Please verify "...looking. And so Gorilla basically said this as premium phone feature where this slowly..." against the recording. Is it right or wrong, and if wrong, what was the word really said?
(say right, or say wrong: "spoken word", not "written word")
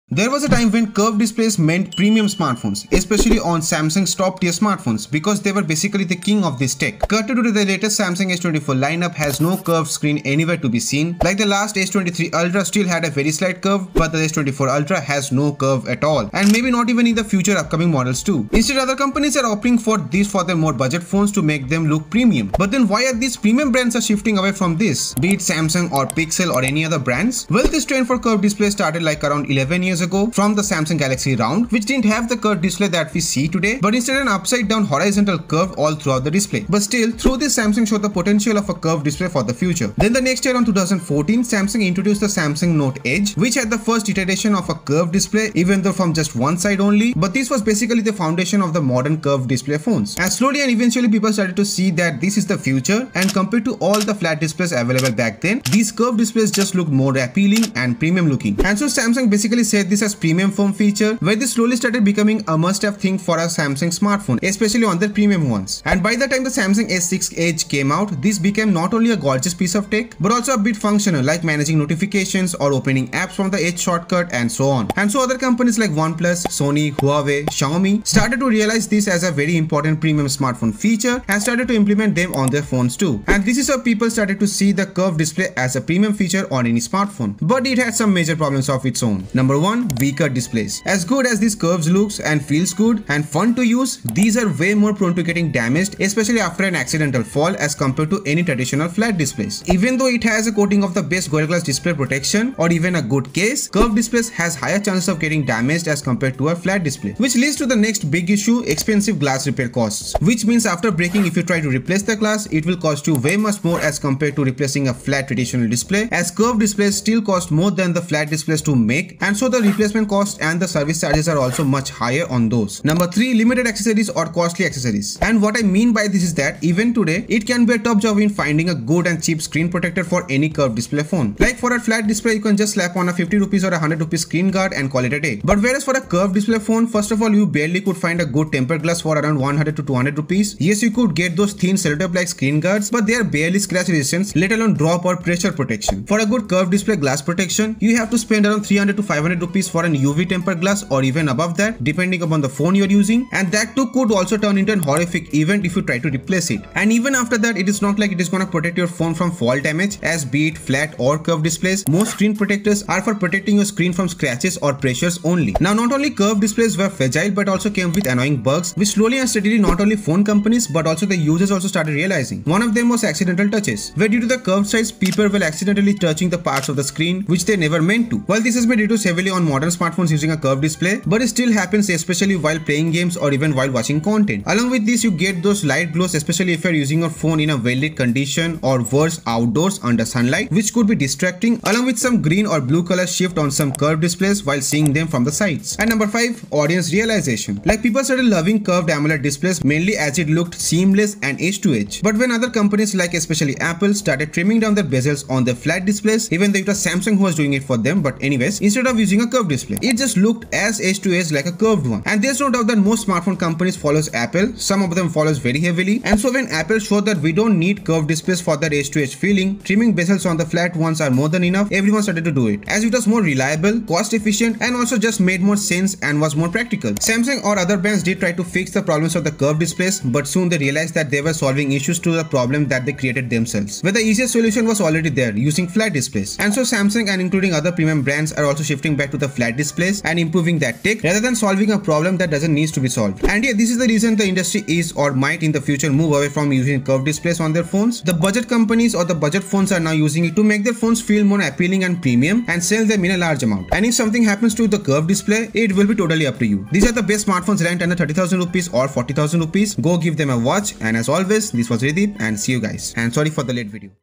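wrong: "Samsung", not "Gorilla".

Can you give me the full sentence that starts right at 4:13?
And if something happens to the curved display, it will be totally up to you.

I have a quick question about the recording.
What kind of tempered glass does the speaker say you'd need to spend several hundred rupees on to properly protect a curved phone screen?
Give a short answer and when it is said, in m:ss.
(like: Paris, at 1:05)
UV tempered glass, at 2:29.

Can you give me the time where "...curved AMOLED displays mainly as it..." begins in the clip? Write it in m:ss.
3:18.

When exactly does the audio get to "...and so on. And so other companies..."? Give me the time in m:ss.
1:14.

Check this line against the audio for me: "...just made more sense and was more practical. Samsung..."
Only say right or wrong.
right.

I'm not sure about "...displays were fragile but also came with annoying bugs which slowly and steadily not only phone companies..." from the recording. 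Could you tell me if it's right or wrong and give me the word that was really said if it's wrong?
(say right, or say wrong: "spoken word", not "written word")
right.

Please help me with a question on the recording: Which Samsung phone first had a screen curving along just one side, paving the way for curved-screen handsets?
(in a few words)
Samsung Note Edge.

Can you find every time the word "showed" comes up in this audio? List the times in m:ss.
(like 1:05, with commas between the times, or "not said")
0:37, 3:36.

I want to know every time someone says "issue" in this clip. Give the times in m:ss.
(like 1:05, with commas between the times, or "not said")
1:48, 3:51.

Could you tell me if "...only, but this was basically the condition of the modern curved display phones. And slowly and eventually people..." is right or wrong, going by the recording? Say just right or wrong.
wrong.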